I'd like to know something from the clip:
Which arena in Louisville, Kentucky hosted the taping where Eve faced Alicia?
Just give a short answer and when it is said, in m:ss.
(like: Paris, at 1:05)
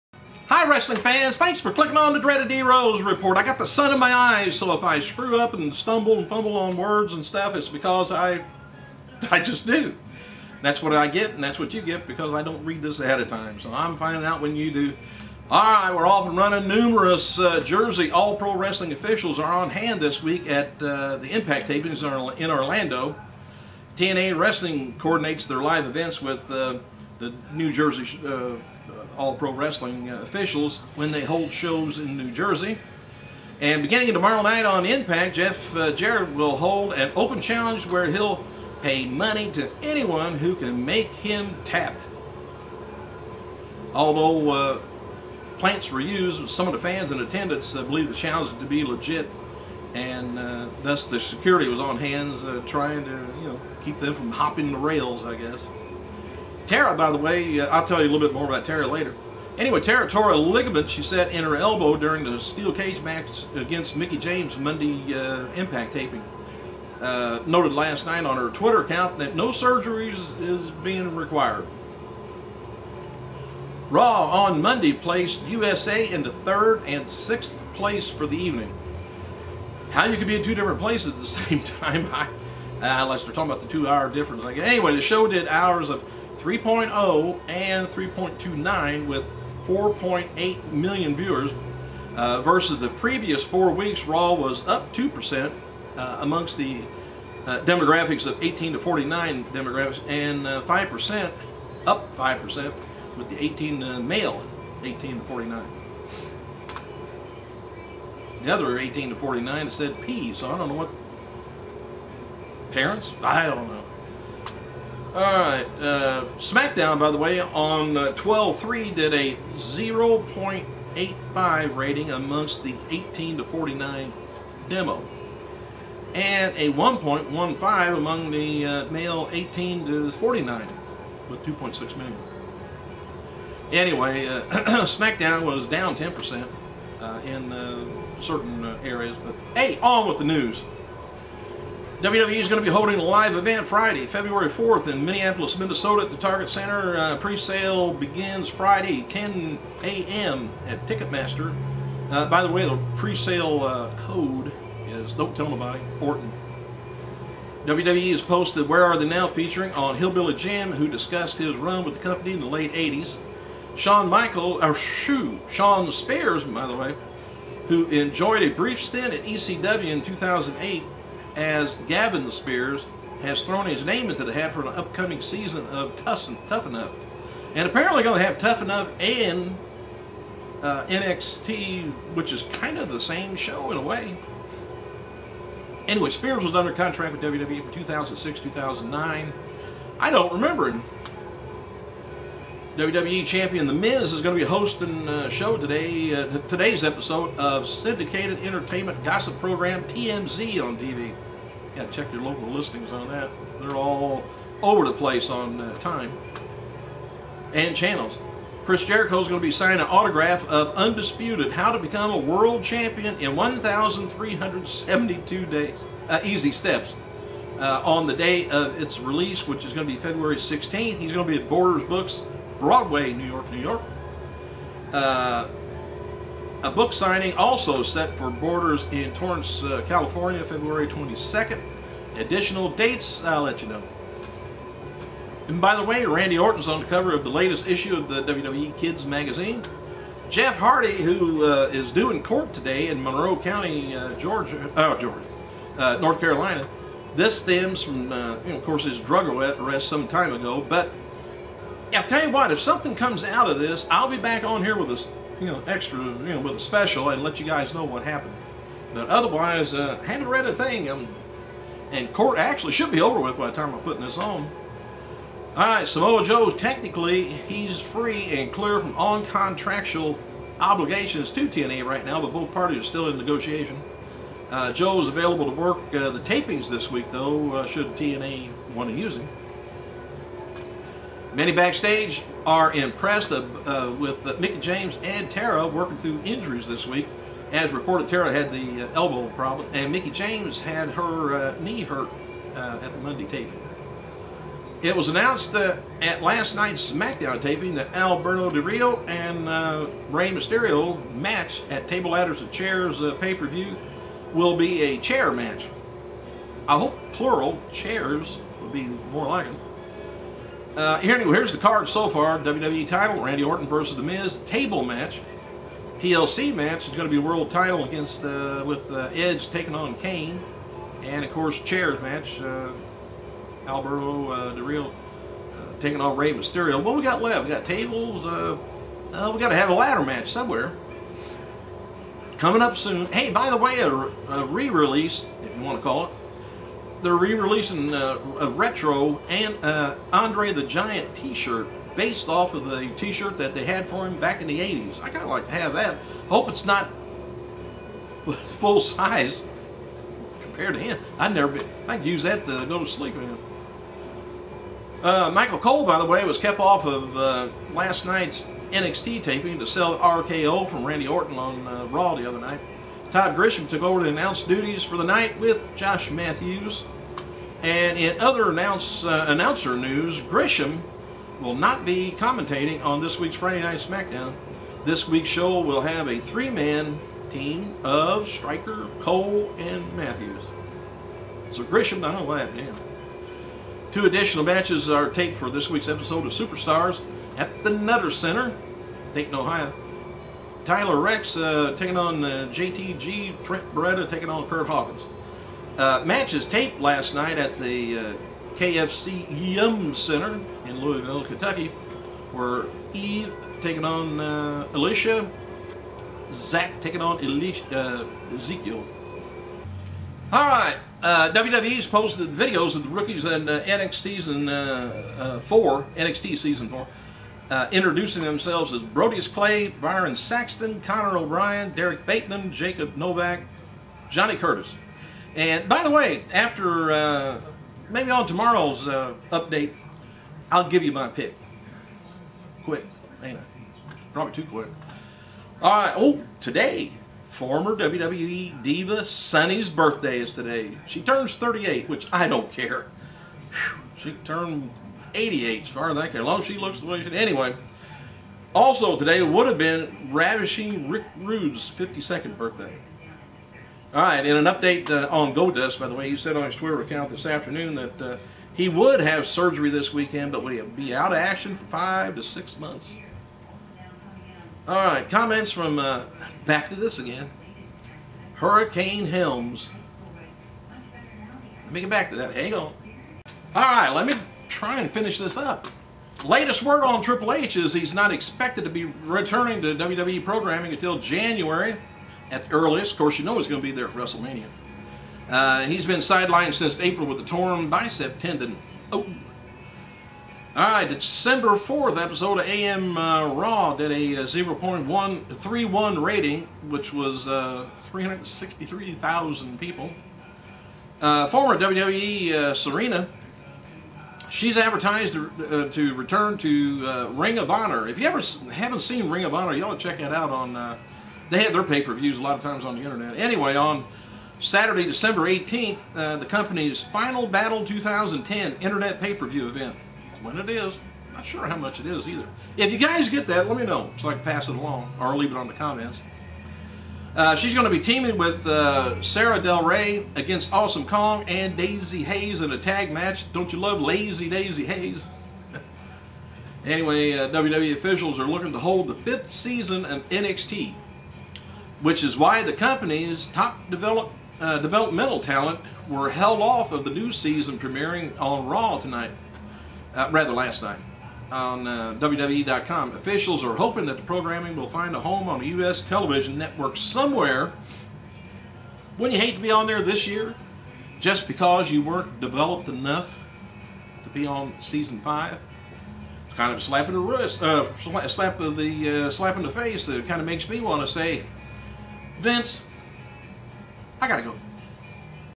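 KFC Yum Center, at 6:38.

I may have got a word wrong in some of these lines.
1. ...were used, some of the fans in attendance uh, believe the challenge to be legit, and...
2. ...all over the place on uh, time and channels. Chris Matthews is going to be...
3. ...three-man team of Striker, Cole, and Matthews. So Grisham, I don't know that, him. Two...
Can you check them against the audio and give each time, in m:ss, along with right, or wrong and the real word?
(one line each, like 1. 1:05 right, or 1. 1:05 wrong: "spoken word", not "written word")
1. 0:45 right
2. 3:23 wrong: "Jericho", not "Matthews"
3. 6:16 right.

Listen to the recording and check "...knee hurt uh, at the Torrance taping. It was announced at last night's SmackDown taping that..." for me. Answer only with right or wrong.
wrong.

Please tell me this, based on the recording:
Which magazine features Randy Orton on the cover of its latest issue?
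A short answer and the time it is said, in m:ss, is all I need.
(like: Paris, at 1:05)
WWE Kids, at 3:58.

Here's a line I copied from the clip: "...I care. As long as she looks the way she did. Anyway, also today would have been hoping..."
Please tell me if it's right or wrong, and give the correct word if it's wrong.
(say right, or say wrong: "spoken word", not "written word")
wrong: "ravishing", not "hoping".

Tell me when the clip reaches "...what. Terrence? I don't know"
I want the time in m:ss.
1:50.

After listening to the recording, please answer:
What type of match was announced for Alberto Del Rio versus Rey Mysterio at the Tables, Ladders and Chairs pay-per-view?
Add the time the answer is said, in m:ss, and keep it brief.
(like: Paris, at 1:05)
Chair match, at 5:04.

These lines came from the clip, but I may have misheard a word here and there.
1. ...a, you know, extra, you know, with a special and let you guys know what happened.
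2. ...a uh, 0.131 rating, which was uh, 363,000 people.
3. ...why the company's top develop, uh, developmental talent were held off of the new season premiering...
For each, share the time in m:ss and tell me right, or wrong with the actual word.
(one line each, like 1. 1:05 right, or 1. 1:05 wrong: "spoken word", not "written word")
1. 4:14 right
2. 8:13 right
3. 9:02 right.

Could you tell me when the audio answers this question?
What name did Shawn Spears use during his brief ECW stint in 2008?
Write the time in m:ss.
2:51.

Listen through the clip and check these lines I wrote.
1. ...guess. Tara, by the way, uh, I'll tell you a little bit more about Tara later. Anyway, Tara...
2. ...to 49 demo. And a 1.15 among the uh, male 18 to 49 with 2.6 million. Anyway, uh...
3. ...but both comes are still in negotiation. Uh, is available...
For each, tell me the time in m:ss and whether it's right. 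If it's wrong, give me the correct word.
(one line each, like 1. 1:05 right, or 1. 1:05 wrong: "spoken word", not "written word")
1. 0:55 right
2. 2:03 right
3. 4:32 wrong: "parties", not "comes".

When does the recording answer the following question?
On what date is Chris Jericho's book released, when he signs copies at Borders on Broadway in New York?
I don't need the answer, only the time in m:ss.
3:39.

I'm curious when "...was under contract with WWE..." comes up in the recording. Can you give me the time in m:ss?
3:06.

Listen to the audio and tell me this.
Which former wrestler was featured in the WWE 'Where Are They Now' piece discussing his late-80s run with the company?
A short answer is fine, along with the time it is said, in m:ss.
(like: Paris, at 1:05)
Hillbilly Jim, at 2:39.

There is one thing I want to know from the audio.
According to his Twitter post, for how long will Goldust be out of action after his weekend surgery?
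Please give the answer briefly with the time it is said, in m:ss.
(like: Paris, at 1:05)
5 to 6 months, at 7:41.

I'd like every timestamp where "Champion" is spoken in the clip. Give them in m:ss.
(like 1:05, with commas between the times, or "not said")
3:13, 3:32.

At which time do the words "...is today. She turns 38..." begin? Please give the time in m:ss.
7:20.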